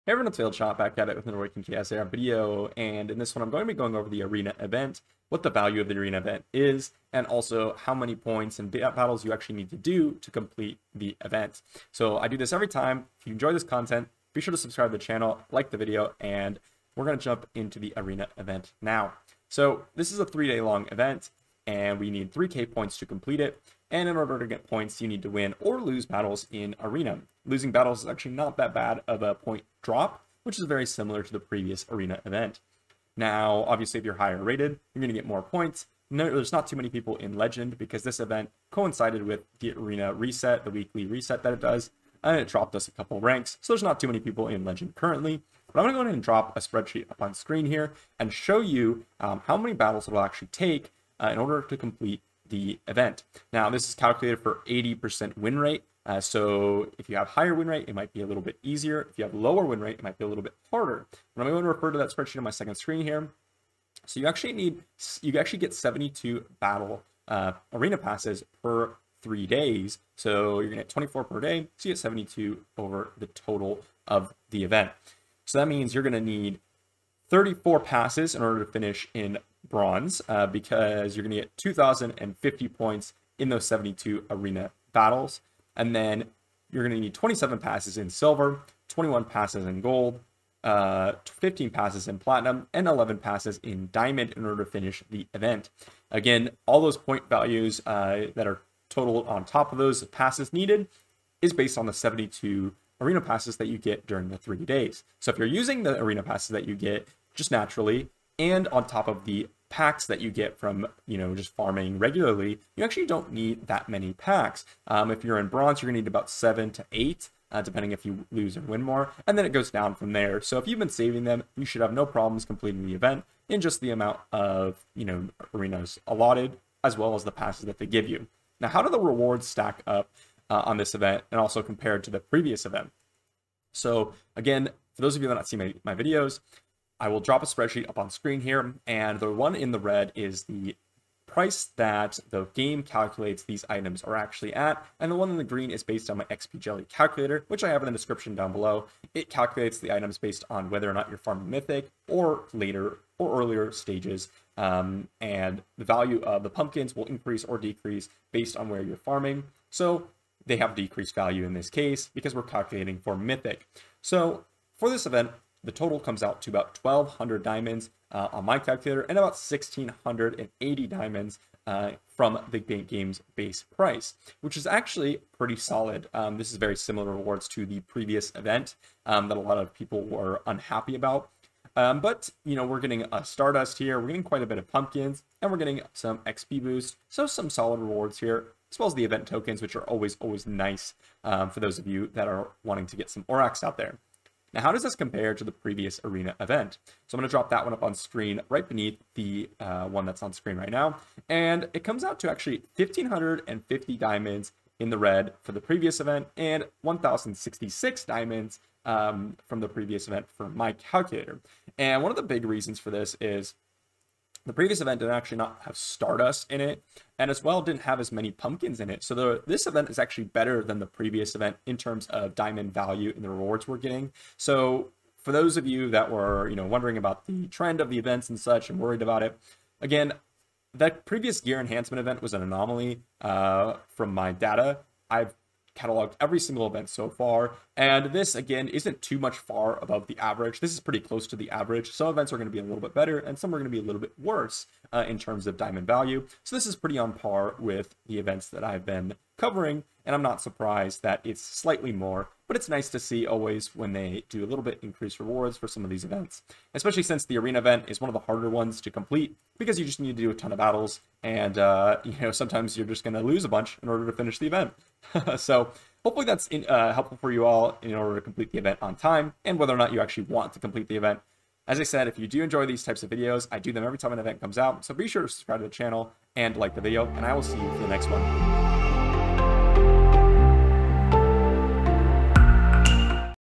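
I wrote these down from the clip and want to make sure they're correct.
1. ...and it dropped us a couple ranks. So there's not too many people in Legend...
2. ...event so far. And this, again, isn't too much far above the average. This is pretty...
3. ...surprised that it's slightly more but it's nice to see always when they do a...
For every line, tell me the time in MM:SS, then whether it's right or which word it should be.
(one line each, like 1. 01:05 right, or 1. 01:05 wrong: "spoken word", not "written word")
1. 00:42 right
2. 03:56 right
3. 04:10 right.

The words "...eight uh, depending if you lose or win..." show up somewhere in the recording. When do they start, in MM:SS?
01:56.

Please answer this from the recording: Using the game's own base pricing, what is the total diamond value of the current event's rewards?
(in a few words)
1,680 diamonds.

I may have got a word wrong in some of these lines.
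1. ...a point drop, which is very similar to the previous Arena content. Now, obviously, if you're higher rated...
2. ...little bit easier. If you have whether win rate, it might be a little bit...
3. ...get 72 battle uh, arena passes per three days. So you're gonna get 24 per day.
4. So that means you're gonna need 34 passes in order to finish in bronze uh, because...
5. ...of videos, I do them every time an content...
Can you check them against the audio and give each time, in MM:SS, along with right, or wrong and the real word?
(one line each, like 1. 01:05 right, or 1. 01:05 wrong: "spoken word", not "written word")
1. 00:29 wrong: "event", not "content"
2. 00:58 wrong: "lower", not "whether"
3. 01:05 right
4. 01:15 right
5. 04:33 wrong: "event", not "content".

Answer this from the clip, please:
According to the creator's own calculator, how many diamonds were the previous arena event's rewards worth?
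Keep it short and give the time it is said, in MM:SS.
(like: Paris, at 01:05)
1,066 diamonds, at 03:26.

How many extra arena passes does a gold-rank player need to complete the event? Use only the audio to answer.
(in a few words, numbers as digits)
21.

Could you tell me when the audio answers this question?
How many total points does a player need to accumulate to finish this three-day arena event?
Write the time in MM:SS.
00:22.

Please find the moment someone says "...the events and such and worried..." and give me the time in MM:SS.
03:47.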